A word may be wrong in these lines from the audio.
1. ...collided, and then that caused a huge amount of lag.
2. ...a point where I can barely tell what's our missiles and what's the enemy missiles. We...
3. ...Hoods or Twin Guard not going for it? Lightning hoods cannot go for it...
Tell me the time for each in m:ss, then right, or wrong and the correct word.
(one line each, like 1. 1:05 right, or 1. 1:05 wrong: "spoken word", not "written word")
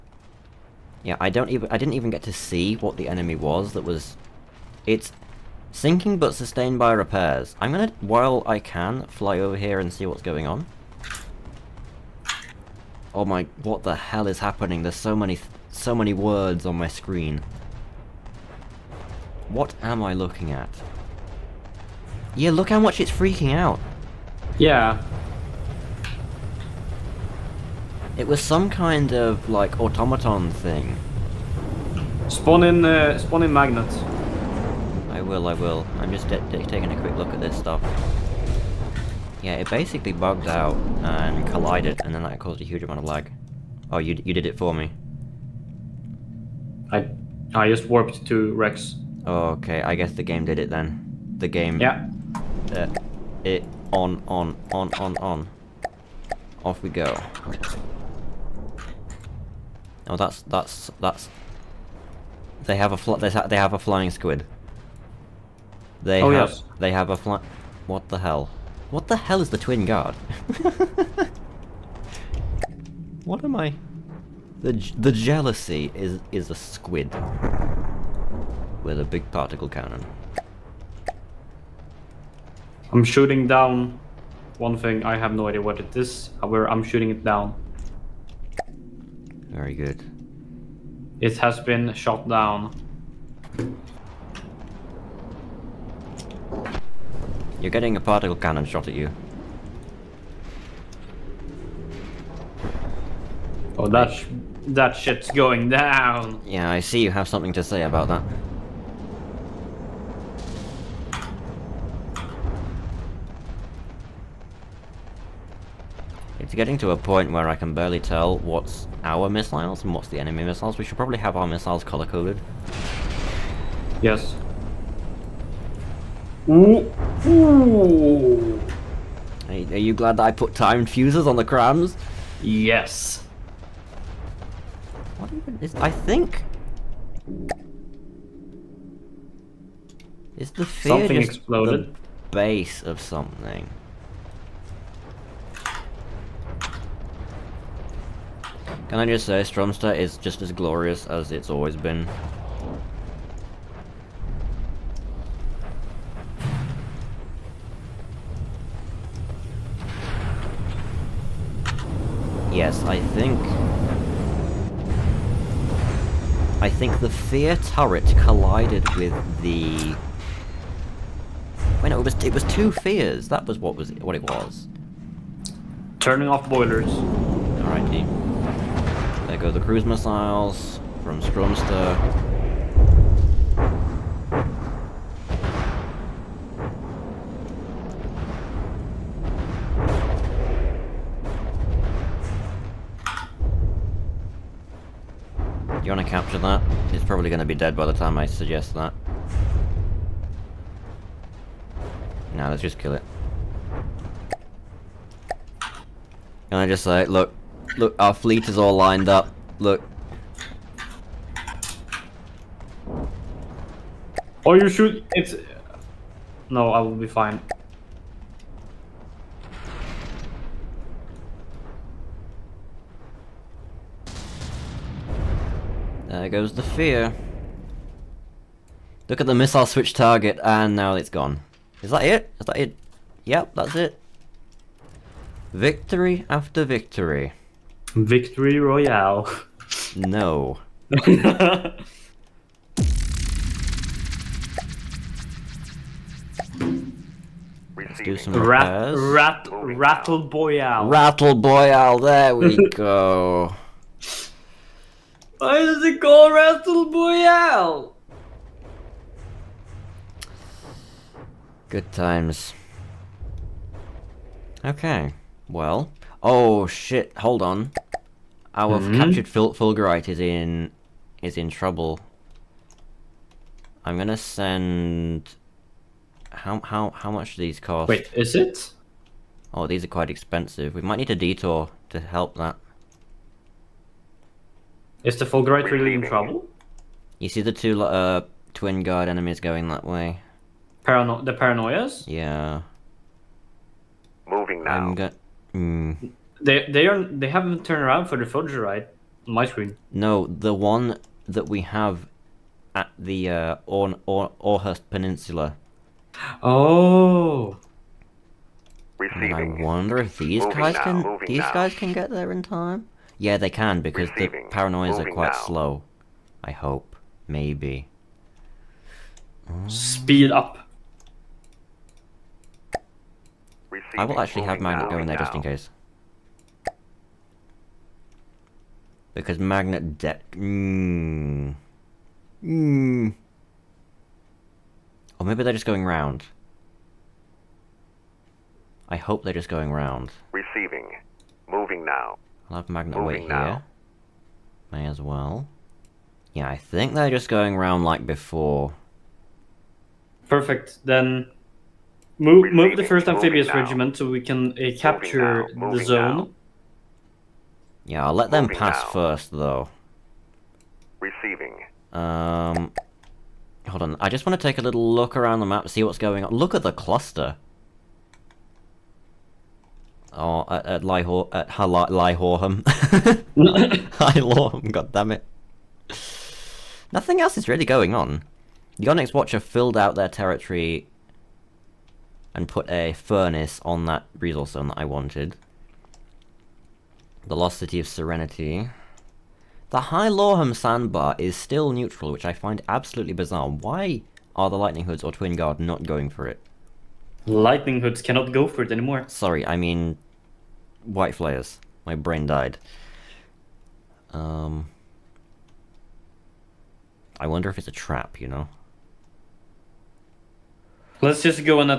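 1. 0:41 right
2. 1:56 right
3. 6:34 right.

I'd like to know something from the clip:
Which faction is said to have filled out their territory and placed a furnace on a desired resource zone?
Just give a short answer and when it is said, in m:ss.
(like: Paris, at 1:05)
The Onyx Watcher, at 6:18.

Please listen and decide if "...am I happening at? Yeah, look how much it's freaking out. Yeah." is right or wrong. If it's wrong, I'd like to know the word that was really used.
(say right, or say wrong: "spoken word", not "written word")
wrong: "looking", not "happening".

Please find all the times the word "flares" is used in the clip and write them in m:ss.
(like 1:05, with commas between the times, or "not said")
6:41.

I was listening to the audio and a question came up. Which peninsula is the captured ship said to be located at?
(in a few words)
Orhurst Peninsula.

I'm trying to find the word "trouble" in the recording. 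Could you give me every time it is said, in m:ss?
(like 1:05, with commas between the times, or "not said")
4:31, 4:46.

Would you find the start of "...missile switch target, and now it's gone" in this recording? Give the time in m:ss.
3:49.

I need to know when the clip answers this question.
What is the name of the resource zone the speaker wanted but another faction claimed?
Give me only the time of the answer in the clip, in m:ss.
6:27.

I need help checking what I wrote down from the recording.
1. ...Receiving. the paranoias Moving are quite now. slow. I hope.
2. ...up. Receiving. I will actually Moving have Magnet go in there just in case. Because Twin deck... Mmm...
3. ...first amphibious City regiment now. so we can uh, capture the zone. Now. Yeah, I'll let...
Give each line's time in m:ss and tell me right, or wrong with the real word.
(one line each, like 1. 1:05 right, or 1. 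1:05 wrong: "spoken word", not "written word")
1. 5:14 right
2. 5:20 wrong: "Magnet", not "Twin"
3. 5:52 wrong: "Moving", not "City".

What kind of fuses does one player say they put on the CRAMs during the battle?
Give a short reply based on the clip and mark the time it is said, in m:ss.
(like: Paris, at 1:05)
Time fuses, at 2:10.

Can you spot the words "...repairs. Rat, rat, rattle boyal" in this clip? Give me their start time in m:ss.
4:08.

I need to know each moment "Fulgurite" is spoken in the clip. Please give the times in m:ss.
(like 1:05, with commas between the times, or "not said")
4:29, 4:45, 4:58.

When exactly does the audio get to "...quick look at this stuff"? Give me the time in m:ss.
0:37.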